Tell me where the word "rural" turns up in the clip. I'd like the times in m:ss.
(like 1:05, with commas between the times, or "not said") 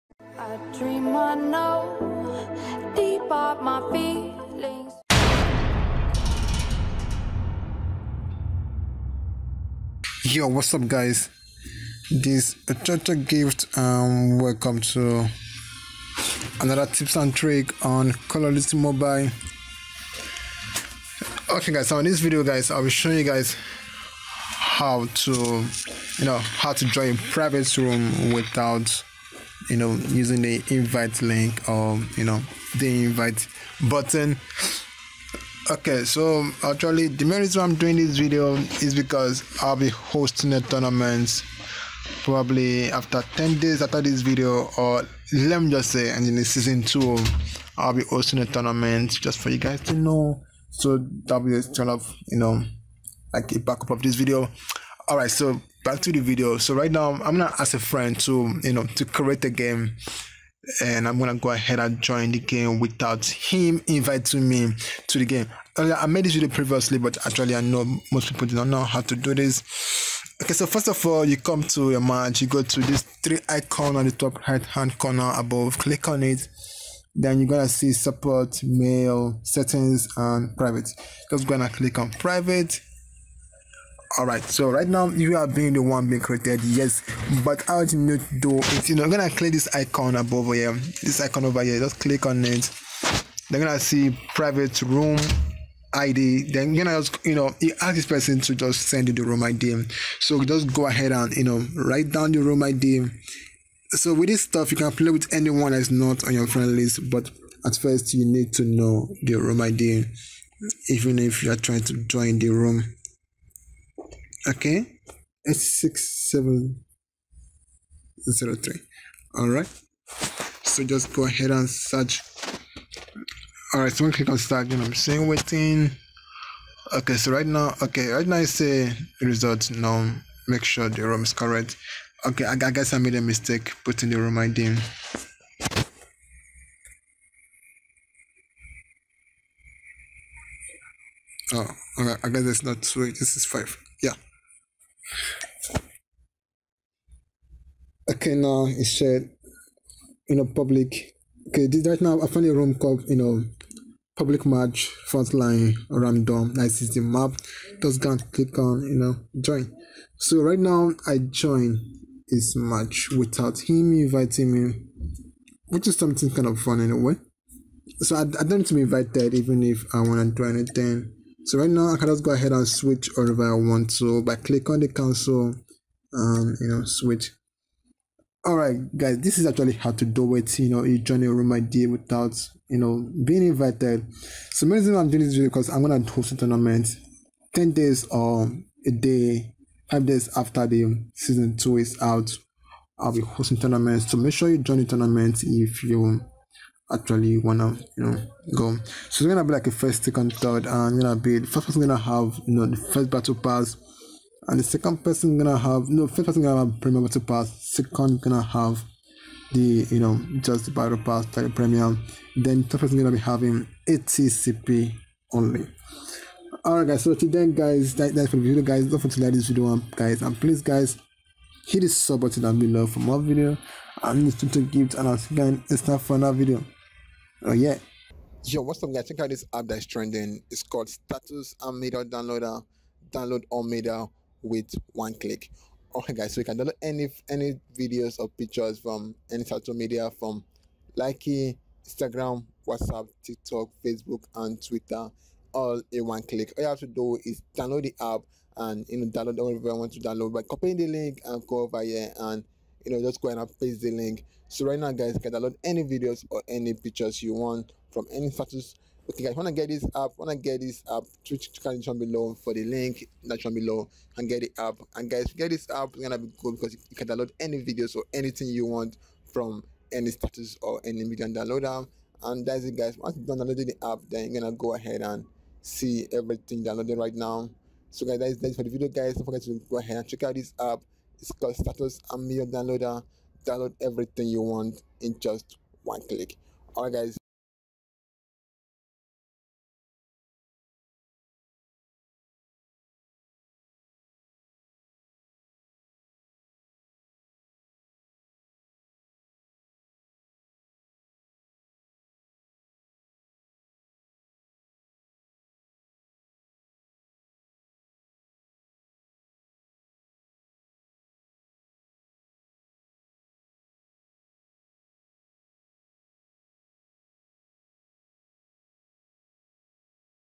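not said.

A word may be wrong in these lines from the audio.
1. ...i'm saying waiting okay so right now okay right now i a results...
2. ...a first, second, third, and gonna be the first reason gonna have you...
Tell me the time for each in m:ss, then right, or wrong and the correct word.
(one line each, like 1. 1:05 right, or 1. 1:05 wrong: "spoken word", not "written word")
1. 2:04 right
2. 3:19 wrong: "person", not "reason".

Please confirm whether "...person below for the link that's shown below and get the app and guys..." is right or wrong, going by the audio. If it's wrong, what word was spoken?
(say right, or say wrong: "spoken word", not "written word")
wrong: "condition", not "person".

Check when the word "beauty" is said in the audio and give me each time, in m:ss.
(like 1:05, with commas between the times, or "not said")
not said.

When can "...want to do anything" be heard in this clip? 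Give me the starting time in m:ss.
2:50.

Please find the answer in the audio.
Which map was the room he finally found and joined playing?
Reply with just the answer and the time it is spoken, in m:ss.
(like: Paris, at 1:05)
Frontline, at 2:35.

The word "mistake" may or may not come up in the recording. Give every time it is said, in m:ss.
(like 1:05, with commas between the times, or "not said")
2:13.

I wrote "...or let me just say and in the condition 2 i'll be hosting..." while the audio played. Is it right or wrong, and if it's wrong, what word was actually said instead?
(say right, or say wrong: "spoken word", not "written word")
wrong: "season", not "condition".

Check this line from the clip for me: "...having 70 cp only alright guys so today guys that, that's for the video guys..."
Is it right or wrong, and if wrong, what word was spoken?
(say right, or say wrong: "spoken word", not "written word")
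wrong: "80", not "70".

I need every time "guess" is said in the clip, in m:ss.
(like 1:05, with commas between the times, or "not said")
2:12, 2:22.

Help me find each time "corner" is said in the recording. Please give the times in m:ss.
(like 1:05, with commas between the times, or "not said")
1:14.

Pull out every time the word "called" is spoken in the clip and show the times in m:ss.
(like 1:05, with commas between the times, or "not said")
2:32, 3:50, 4:41.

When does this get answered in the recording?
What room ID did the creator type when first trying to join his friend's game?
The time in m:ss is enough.
1:55.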